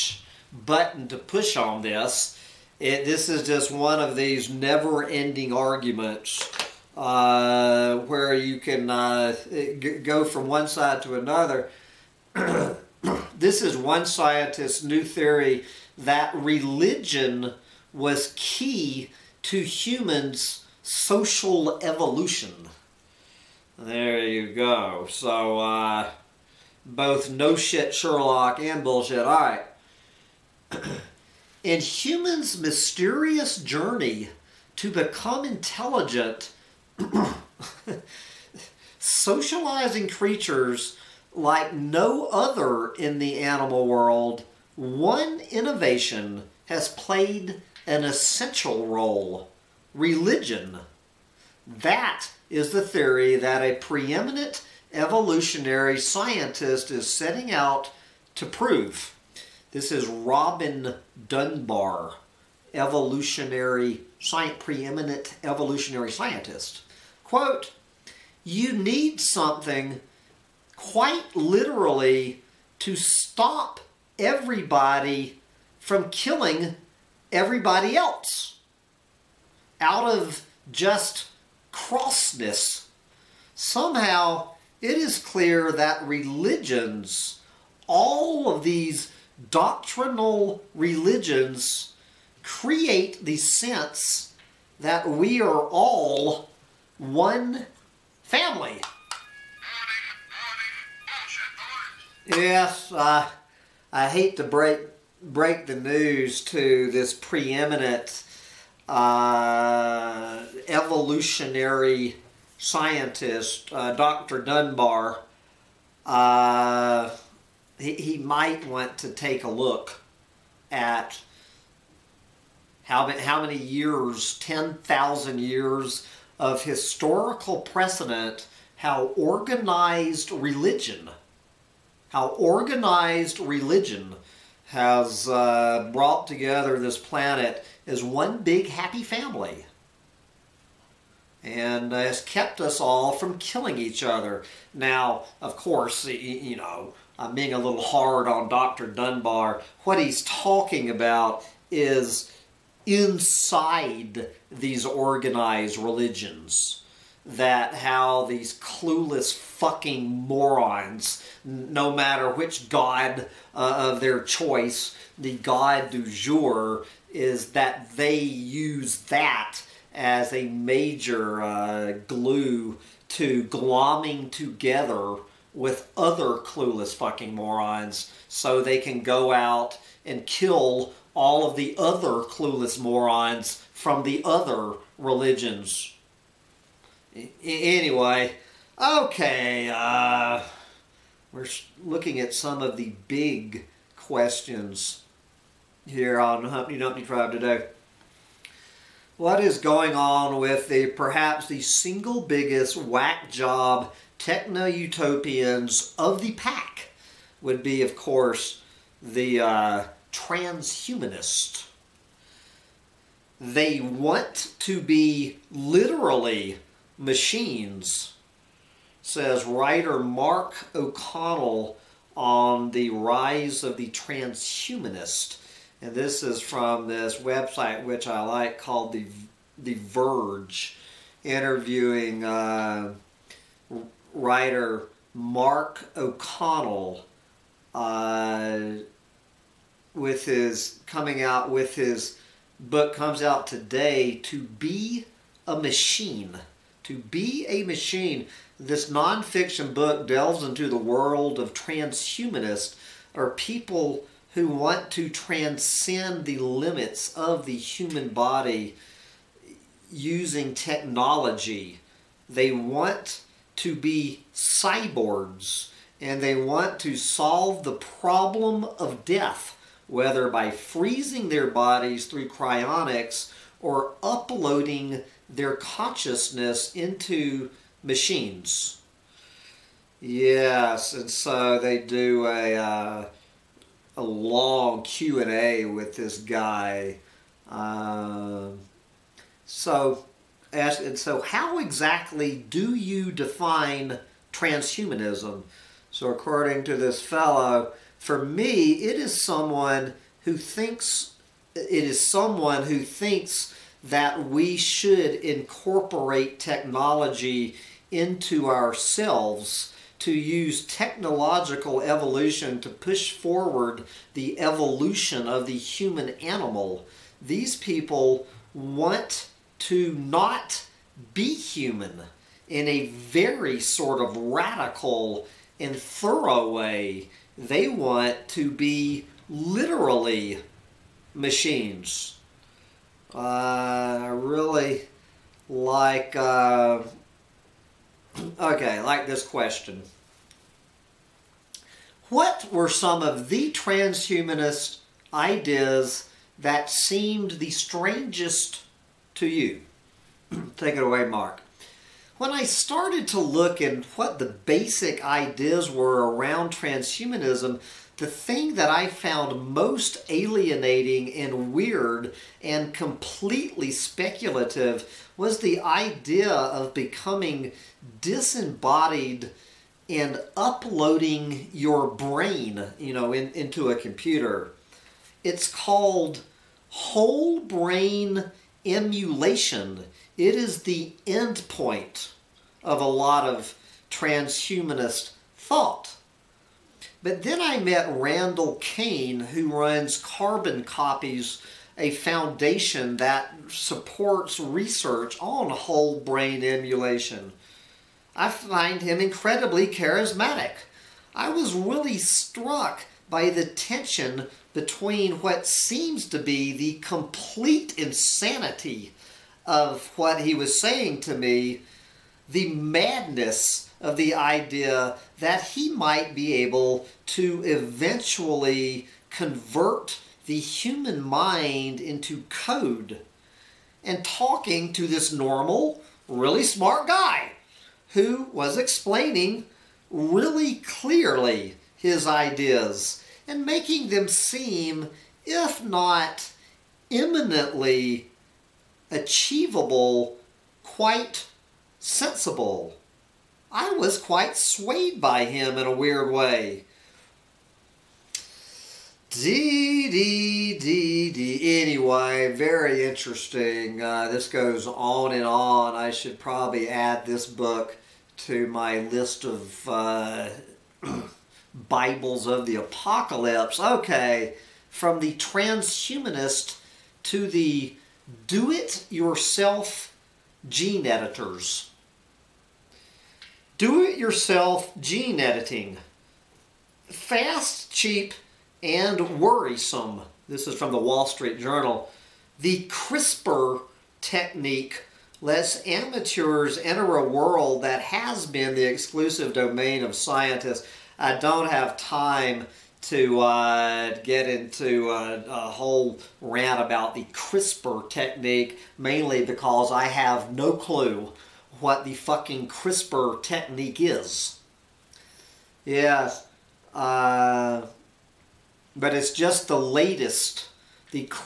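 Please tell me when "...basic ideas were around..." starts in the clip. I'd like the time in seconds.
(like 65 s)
354 s.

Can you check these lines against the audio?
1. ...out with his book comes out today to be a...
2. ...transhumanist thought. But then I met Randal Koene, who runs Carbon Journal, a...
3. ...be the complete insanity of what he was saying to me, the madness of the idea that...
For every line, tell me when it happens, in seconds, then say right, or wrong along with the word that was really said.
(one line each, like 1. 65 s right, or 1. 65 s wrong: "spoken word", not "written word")
1. 241 s right
2. 383 s wrong: "Copies", not "Journal"
3. 406 s right.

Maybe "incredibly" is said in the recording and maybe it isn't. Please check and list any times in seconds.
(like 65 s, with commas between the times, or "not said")
398 s.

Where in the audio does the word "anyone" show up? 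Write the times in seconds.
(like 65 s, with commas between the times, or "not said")
not said.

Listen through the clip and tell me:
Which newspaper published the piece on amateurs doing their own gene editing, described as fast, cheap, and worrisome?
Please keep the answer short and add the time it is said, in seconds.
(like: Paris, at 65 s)
Wall Street Journal, at 480 s.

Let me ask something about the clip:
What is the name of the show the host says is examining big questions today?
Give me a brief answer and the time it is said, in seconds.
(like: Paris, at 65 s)
Humpty Dumpty Tribe, at 196 s.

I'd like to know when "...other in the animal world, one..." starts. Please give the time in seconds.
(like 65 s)
42 s.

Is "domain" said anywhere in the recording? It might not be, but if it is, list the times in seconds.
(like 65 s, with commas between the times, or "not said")
489 s.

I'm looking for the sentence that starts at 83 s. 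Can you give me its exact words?
Somehow, it is clear that religions, all of these doctrinal religions, create the sense that we are all one family.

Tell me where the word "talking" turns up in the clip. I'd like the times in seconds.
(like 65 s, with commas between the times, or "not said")
150 s, 424 s.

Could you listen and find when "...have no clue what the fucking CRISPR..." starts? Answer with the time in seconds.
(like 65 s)
499 s.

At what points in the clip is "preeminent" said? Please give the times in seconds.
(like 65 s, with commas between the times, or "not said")
53 s, 64 s, 107 s.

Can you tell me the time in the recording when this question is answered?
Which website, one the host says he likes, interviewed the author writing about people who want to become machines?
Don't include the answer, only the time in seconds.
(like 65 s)
229 s.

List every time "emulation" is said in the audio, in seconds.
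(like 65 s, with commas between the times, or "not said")
378 s, 396 s.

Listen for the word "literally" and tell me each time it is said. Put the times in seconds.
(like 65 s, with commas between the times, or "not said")
71 s, 215 s, 329 s.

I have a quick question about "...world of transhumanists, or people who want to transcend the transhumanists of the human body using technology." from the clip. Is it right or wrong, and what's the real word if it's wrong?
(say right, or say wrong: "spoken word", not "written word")
wrong: "limits", not "transhumanists".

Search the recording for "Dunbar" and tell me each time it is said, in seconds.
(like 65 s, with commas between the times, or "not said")
61 s, 114 s, 148 s.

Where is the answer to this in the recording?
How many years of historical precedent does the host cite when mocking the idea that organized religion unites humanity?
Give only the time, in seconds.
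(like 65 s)
124 s.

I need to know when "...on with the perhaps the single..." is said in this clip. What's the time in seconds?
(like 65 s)
199 s.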